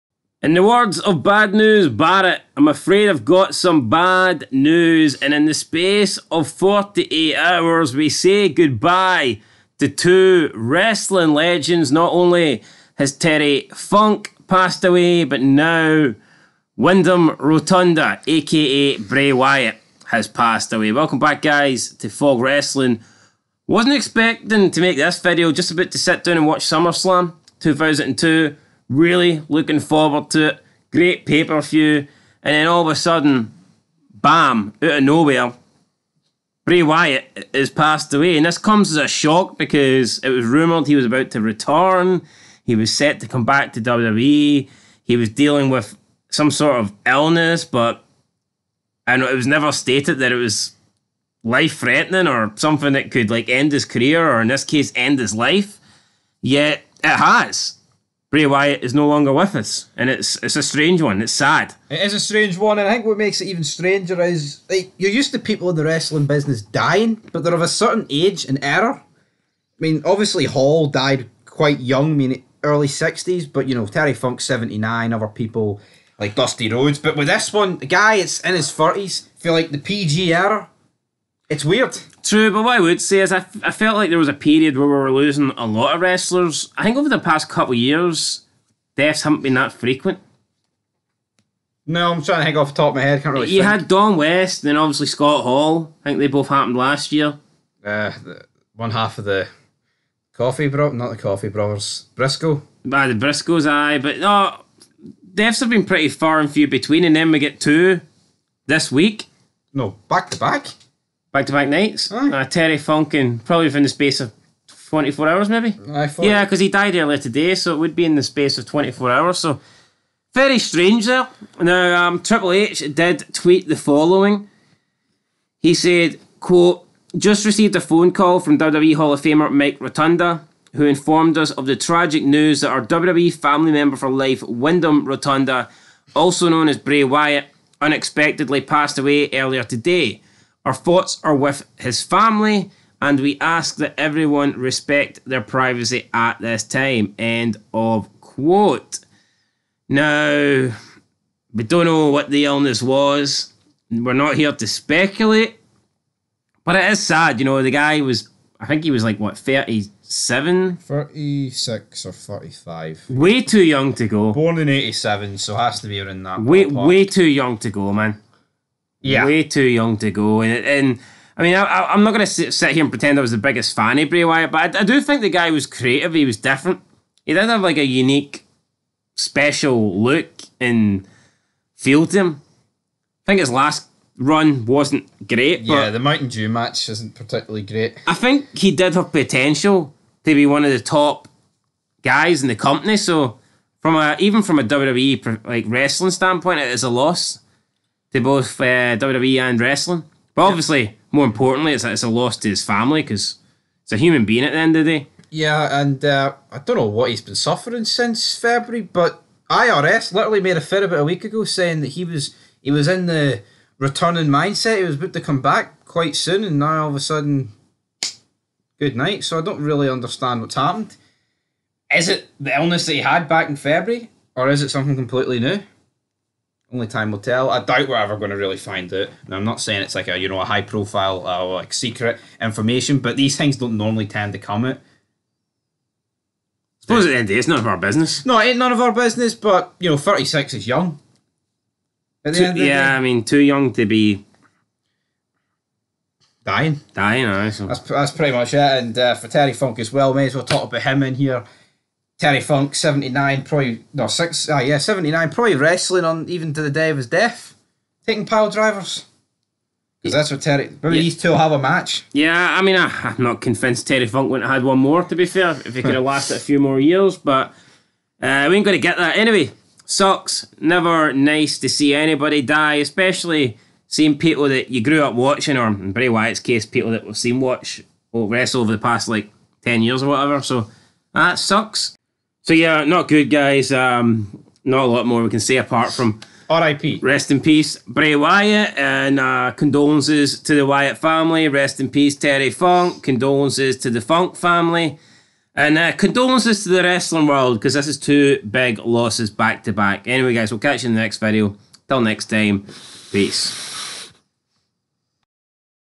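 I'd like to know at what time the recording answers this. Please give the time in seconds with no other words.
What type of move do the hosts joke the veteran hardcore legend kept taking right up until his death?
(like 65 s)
258 s.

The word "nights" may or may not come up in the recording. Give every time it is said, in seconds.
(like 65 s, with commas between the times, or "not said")
111 s, 218 s.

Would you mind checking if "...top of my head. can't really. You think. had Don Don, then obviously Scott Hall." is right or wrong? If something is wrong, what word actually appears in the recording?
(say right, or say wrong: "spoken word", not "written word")
wrong: "West", not "Don".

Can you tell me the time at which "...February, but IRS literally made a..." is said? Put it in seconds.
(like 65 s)
208 s.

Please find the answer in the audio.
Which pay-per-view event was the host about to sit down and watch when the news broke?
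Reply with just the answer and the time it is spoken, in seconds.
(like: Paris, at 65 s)
SummerSlam 2002, at 26 s.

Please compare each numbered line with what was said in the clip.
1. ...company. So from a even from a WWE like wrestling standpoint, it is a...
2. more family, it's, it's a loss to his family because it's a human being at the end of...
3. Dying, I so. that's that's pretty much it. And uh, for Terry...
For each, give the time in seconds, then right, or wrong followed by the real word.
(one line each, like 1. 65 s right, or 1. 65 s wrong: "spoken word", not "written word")
1. 192 s right
2. 201 s wrong: "importantly", not "family"
3. 246 s right.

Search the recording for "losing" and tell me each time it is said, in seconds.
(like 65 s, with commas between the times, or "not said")
85 s.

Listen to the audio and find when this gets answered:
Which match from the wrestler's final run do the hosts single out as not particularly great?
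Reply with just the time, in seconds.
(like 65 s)
185 s.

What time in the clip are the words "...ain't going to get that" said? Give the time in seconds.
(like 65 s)
268 s.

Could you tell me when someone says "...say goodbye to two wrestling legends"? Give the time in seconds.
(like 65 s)
8 s.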